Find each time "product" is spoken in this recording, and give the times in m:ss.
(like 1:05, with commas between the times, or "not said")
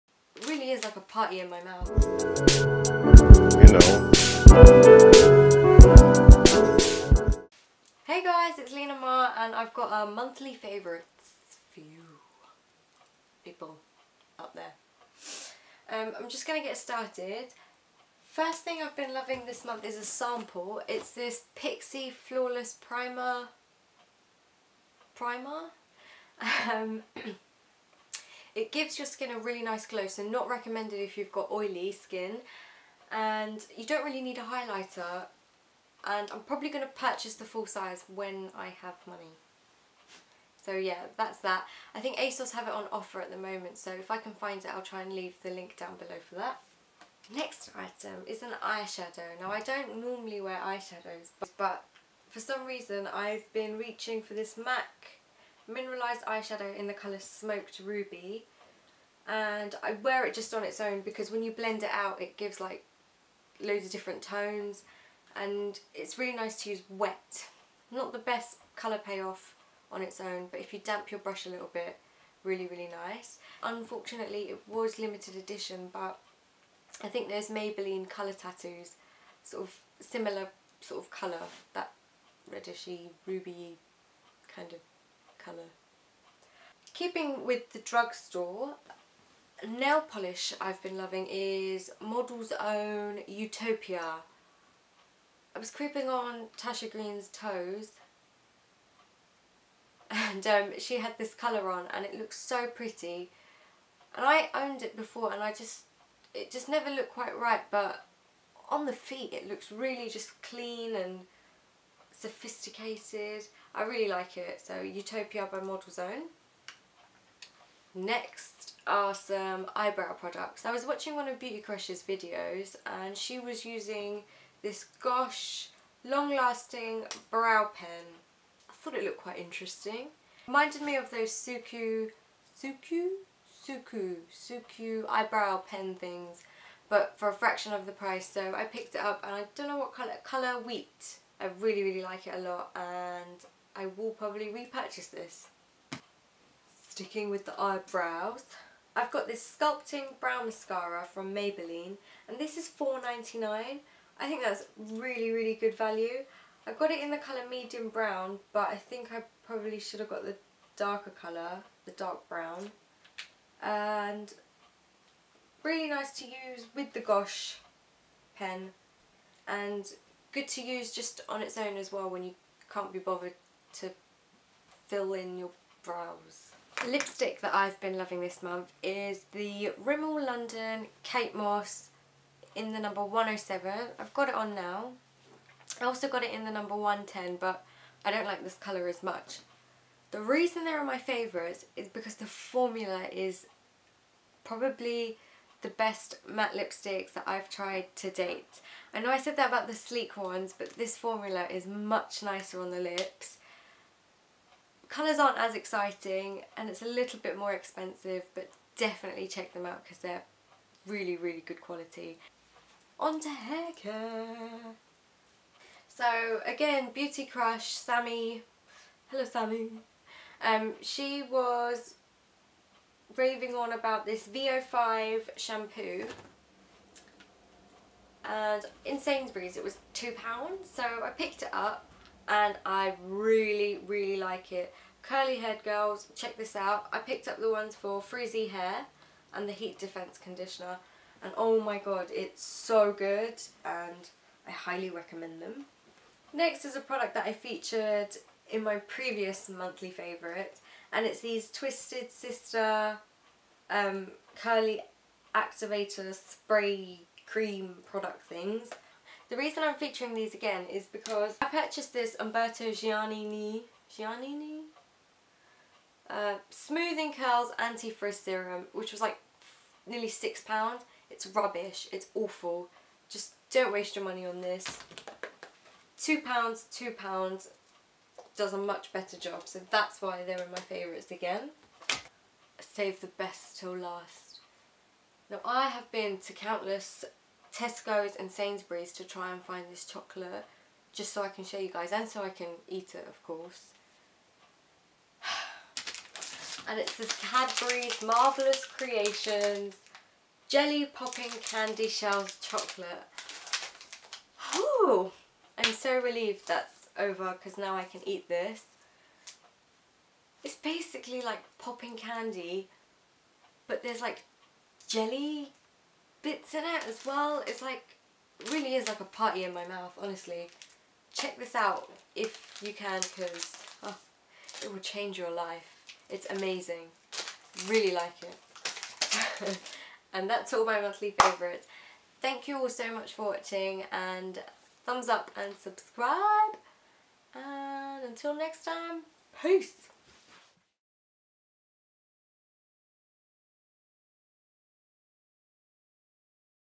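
2:00, 4:06, 4:17.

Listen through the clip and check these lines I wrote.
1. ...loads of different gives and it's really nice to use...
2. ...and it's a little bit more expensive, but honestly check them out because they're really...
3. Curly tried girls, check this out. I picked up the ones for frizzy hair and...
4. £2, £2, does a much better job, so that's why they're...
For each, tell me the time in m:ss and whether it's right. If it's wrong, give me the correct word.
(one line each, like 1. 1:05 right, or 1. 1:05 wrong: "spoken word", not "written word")
1. 1:03 wrong: "tones", not "gives"
2. 3:26 wrong: "definitely", not "honestly"
3. 3:55 wrong: "haired", not "tried"
4. 4:35 right.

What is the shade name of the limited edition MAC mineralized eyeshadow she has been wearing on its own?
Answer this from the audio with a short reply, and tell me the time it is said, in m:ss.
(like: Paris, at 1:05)
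Smoked Ruby, at 0:57.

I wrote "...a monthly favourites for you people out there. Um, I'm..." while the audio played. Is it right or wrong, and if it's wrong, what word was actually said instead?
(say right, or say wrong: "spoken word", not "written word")
right.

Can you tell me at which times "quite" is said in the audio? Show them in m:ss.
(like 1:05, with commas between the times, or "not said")
1:47, 2:09.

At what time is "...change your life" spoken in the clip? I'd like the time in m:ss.
5:24.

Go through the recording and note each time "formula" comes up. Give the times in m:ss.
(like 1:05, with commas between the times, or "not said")
3:12, 3:20.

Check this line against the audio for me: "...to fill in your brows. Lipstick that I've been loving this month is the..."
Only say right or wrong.
right.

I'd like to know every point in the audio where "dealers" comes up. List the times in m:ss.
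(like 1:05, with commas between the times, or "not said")
not said.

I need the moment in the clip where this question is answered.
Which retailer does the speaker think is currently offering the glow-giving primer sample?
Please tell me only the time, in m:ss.
0:42.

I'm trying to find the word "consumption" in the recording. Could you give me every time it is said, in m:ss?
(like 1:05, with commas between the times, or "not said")
not said.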